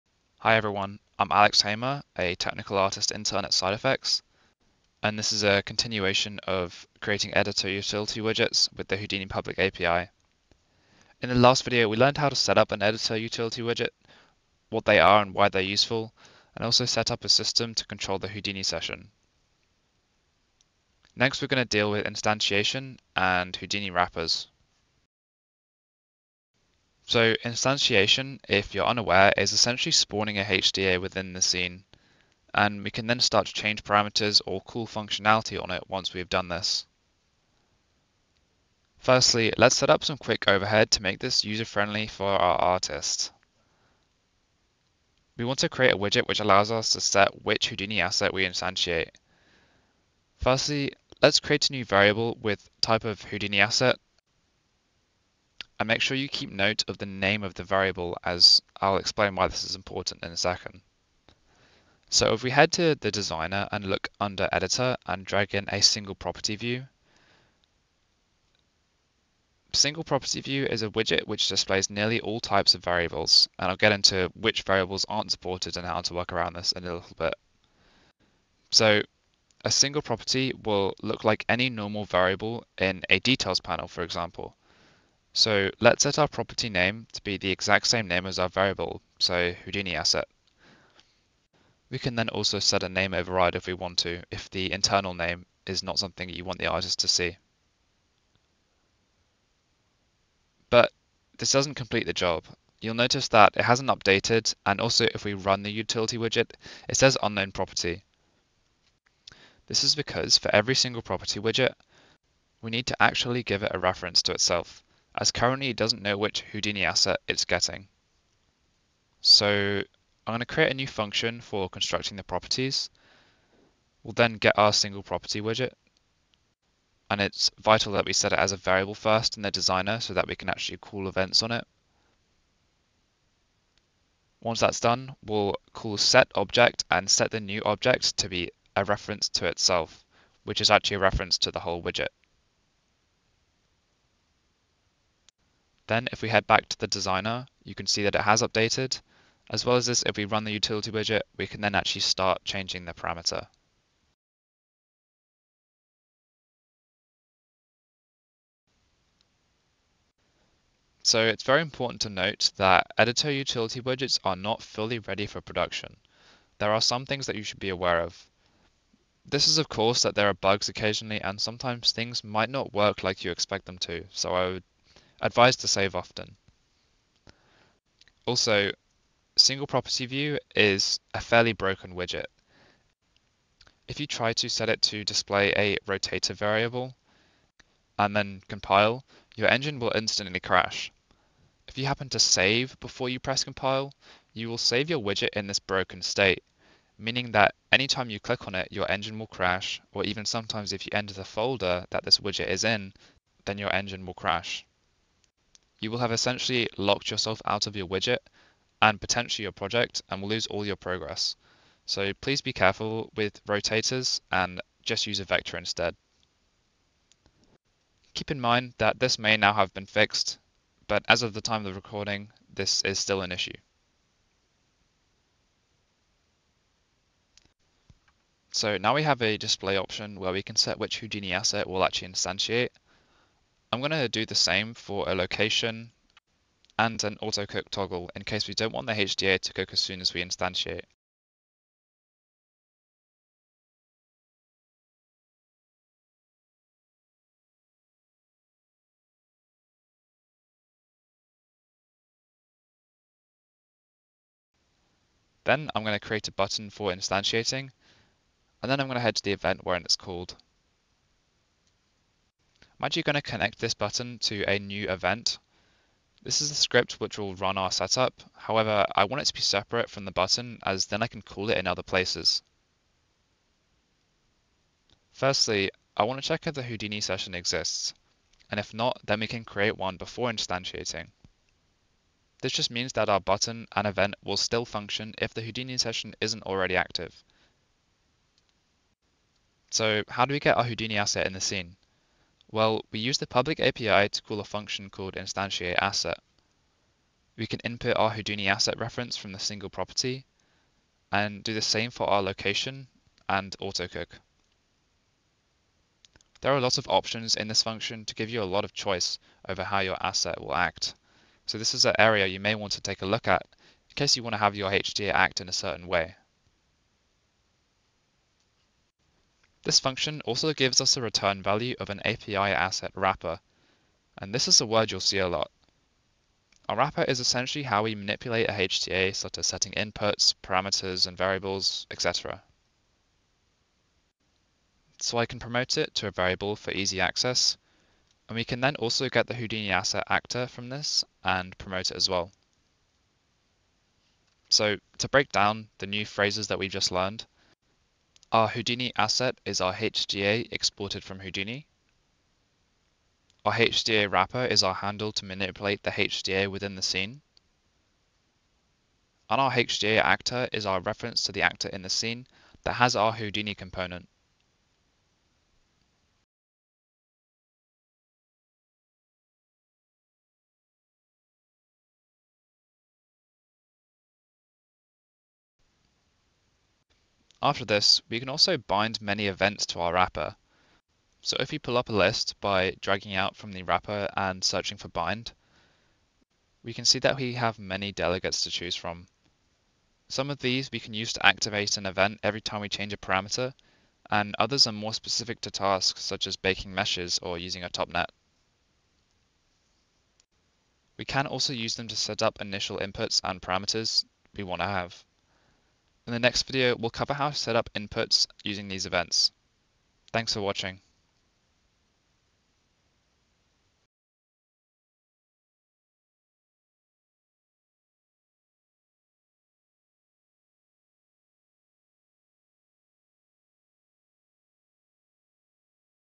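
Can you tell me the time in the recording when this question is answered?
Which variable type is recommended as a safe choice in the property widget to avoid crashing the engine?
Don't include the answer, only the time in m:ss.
3:35.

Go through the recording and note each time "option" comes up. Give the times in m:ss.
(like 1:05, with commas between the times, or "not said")
3:49, 5:06.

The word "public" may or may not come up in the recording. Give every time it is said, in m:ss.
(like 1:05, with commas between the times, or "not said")
0:09, 4:53.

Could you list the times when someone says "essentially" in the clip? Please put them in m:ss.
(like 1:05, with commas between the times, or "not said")
0:29, 3:26, 5:27.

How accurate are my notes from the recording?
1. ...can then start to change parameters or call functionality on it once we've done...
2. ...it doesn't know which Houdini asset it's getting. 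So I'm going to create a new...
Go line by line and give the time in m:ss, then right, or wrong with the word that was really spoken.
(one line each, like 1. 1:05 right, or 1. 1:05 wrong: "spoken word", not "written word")
1. 0:32 right
2. 1:55 right.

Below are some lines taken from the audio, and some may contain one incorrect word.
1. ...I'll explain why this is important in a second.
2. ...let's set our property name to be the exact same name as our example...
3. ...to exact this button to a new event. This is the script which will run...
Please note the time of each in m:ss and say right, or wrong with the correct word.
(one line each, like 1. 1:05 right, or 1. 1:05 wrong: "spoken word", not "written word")
1. 0:58 right
2. 1:25 wrong: "variable", not "example"
3. 4:23 wrong: "connect", not "exact".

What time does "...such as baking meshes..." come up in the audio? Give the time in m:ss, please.
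6:36.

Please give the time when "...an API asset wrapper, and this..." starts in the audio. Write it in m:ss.
5:21.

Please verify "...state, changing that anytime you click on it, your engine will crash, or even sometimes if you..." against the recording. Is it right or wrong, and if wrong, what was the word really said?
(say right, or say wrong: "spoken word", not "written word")
wrong: "meaning", not "changing".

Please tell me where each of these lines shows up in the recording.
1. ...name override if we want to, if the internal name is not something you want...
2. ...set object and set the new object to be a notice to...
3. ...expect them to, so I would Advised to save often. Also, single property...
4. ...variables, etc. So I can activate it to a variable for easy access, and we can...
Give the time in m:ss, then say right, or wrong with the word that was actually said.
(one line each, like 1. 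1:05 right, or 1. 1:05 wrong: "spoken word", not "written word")
1. 1:32 right
2. 2:15 wrong: "reference", not "notice"
3. 2:53 right
4. 5:31 wrong: "promote", not "activate".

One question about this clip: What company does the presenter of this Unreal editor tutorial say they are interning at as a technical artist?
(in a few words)
SideFX.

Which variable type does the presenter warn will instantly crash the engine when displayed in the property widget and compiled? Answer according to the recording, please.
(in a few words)
rotator.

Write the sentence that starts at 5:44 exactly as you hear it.
So to break down the new phrases that we've just learned, our Houdini asset is our HDA exported from Houdini.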